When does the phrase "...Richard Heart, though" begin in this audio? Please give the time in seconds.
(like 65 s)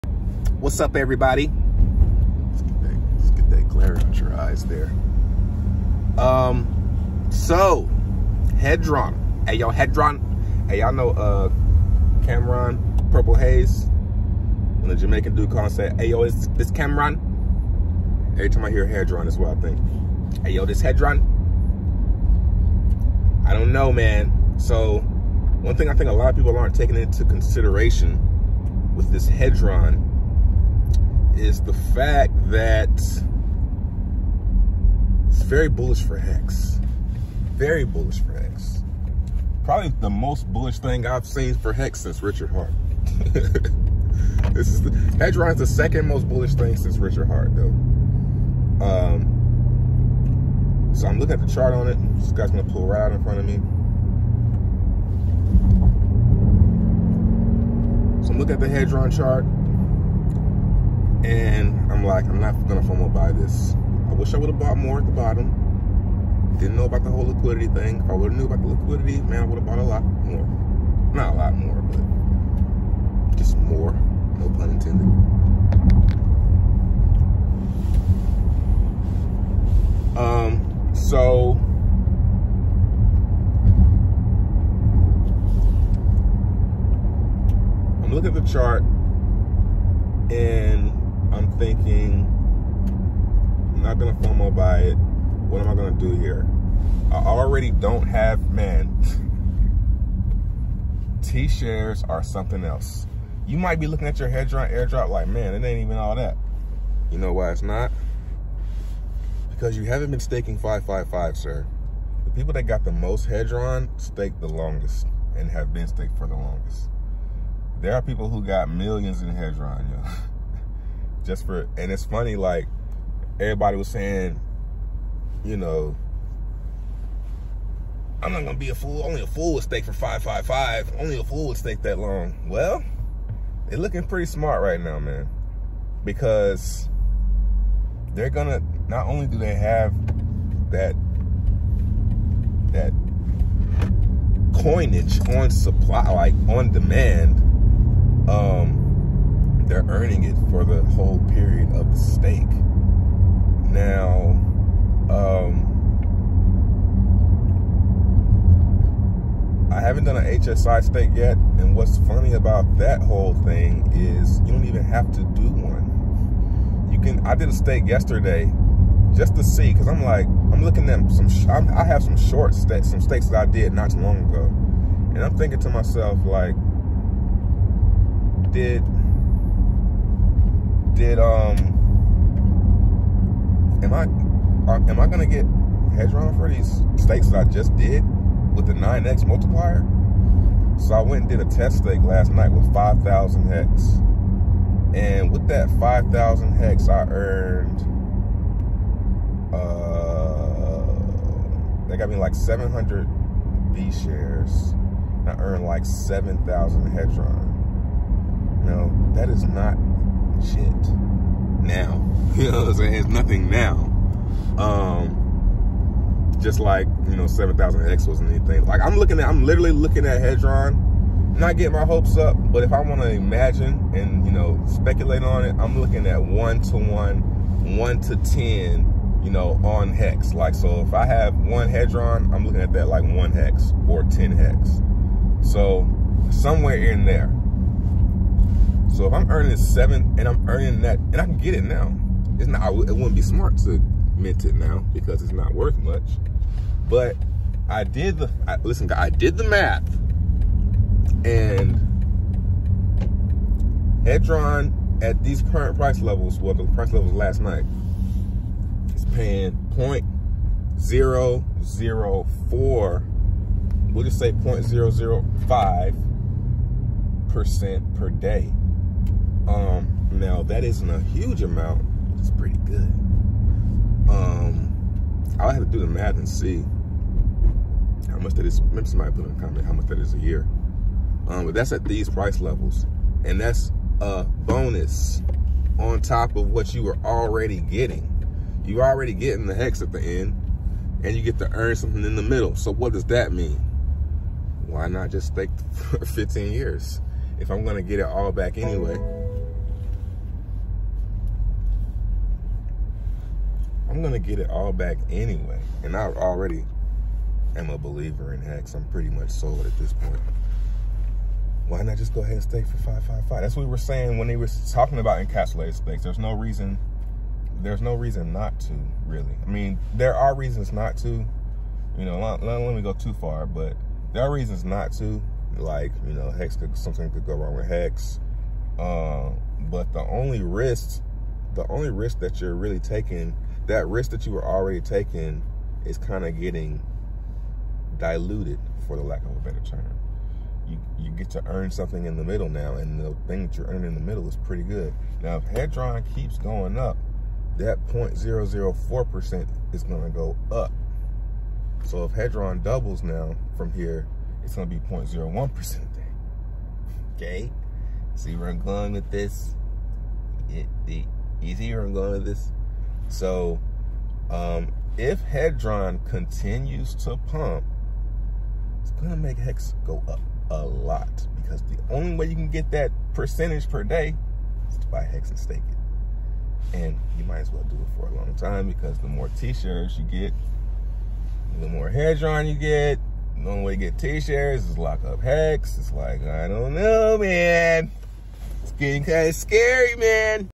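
46 s.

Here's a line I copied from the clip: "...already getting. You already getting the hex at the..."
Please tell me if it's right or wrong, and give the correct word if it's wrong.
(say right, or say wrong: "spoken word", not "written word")
right.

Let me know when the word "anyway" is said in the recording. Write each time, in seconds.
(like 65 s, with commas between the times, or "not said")
298 s, 305 s.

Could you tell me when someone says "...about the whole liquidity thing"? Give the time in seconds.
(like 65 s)
66 s.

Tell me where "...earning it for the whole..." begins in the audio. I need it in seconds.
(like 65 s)
149 s.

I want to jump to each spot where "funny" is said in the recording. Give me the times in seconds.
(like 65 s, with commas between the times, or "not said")
122 s, 161 s.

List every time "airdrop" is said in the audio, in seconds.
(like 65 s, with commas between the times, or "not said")
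104 s.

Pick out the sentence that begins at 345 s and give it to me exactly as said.
Now, if Hedron keeps going up, that 0.004% is going to go up.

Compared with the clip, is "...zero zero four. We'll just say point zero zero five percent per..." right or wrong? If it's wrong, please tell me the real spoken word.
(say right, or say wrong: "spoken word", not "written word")
right.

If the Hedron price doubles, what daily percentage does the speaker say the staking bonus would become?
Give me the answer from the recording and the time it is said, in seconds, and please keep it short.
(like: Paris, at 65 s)
0.01%, at 354 s.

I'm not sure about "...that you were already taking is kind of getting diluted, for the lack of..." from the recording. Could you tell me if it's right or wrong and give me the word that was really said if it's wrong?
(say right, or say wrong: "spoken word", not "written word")
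right.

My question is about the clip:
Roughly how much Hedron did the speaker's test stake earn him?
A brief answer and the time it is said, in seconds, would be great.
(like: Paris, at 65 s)
7,000, at 205 s.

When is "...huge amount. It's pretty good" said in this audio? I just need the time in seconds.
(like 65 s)
270 s.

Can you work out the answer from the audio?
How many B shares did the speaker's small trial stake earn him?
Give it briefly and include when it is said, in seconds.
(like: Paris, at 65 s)
700, at 202 s.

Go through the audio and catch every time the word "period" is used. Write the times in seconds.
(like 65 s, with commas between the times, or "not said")
151 s.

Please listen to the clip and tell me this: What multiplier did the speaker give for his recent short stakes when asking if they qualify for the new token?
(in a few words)
9x.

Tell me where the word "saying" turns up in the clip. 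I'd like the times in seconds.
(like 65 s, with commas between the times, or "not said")
123 s, 212 s, 313 s.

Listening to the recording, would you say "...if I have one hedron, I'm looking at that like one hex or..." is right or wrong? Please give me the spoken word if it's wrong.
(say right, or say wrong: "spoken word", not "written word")
right.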